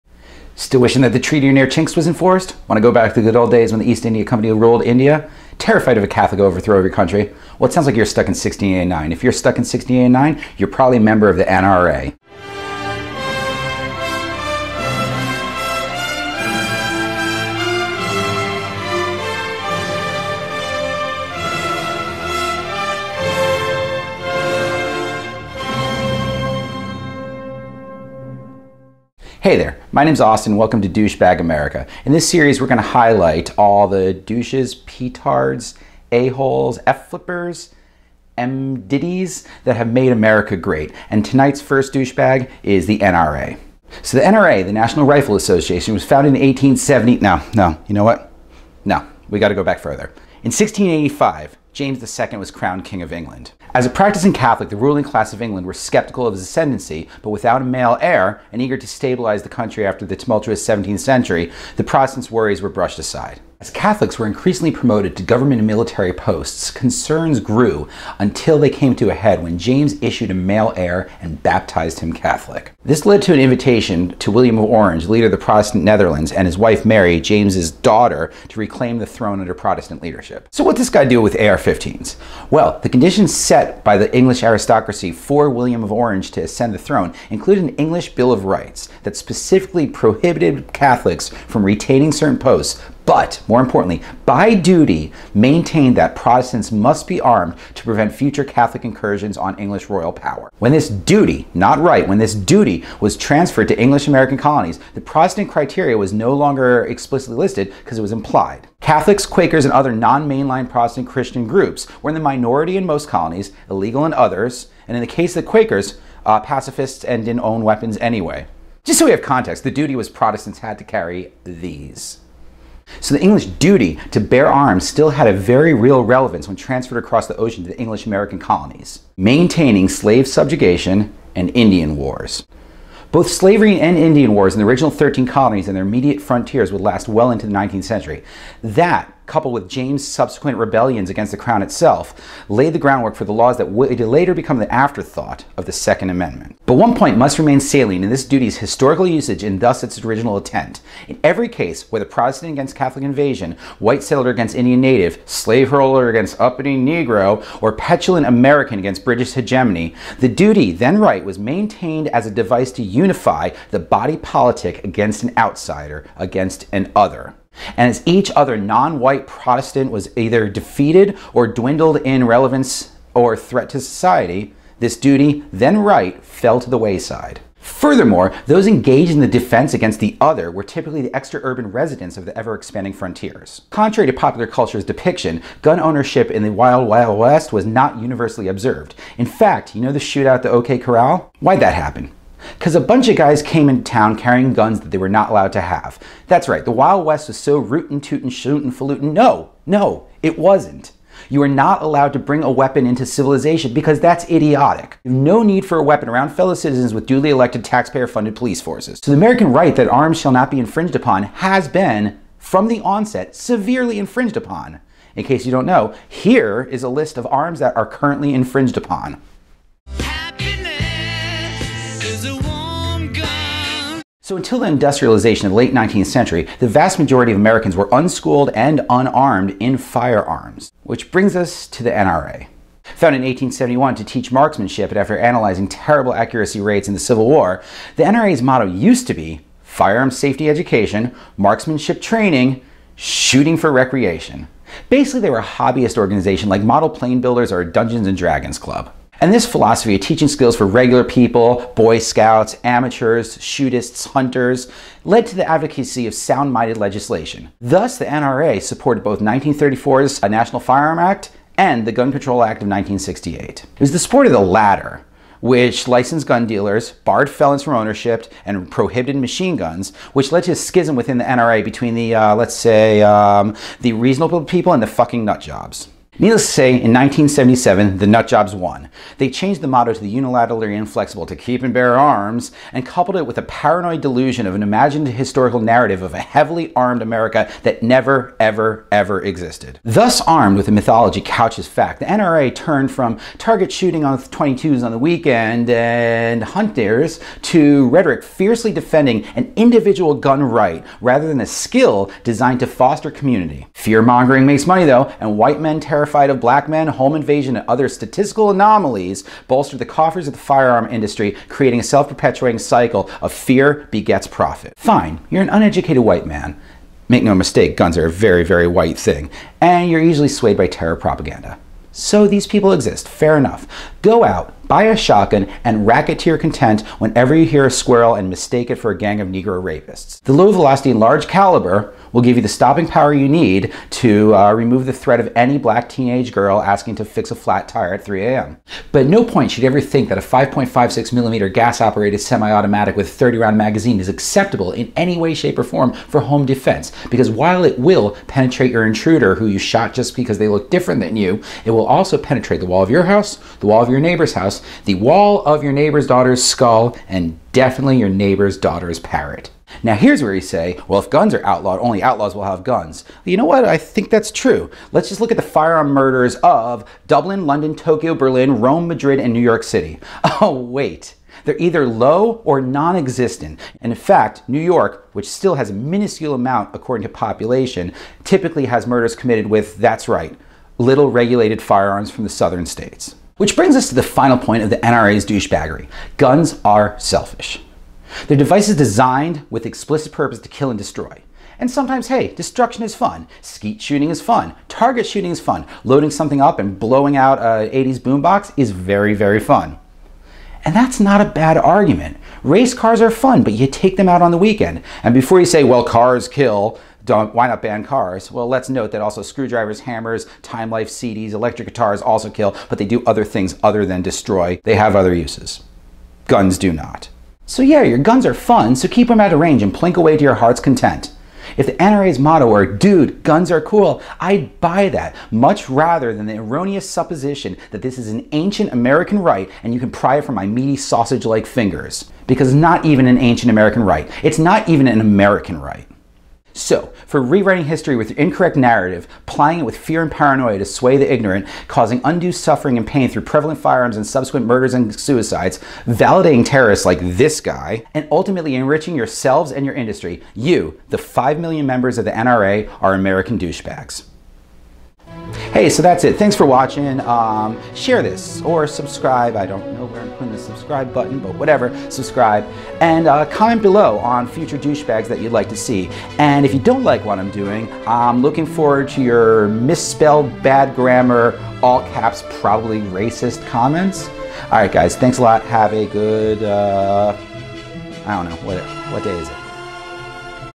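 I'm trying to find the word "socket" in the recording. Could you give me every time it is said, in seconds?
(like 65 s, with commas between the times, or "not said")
not said.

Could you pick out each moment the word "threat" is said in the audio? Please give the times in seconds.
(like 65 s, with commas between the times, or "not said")
173 s, 334 s.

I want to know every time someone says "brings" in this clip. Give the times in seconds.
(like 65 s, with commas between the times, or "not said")
202 s, 231 s, 383 s.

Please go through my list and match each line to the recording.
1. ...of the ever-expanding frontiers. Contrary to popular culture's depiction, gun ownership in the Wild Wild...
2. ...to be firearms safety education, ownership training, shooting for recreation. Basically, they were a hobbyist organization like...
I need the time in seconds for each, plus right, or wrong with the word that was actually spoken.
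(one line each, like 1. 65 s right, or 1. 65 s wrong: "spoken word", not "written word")
1. 182 s right
2. 239 s wrong: "marksmanship", not "ownership".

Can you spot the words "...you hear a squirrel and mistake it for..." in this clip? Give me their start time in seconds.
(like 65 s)
327 s.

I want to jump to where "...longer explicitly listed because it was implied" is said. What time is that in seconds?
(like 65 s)
106 s.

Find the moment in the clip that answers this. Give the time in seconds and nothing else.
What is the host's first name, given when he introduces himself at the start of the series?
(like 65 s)
30 s.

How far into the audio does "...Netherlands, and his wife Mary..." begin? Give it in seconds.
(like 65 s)
75 s.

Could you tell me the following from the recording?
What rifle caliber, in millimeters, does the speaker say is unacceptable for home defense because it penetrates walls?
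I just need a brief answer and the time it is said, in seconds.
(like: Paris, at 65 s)
5.56 millimeter, at 340 s.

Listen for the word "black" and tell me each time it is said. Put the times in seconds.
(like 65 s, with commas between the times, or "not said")
306 s, 335 s.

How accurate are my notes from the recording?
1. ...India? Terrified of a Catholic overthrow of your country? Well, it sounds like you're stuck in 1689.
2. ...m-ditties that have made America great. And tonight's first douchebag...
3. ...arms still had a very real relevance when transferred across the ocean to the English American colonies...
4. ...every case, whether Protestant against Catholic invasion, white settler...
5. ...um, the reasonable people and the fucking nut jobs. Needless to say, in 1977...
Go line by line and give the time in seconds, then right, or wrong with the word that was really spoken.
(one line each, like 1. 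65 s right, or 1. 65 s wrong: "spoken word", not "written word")
1. 4 s right
2. 38 s right
3. 124 s right
4. 151 s right
5. 273 s right.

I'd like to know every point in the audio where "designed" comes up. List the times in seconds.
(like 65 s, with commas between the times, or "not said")
302 s, 388 s.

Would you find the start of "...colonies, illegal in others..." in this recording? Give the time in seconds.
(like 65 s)
113 s.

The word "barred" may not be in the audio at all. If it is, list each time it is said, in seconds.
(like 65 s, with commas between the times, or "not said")
267 s.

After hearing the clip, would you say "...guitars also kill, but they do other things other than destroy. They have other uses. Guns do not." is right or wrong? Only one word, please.
right.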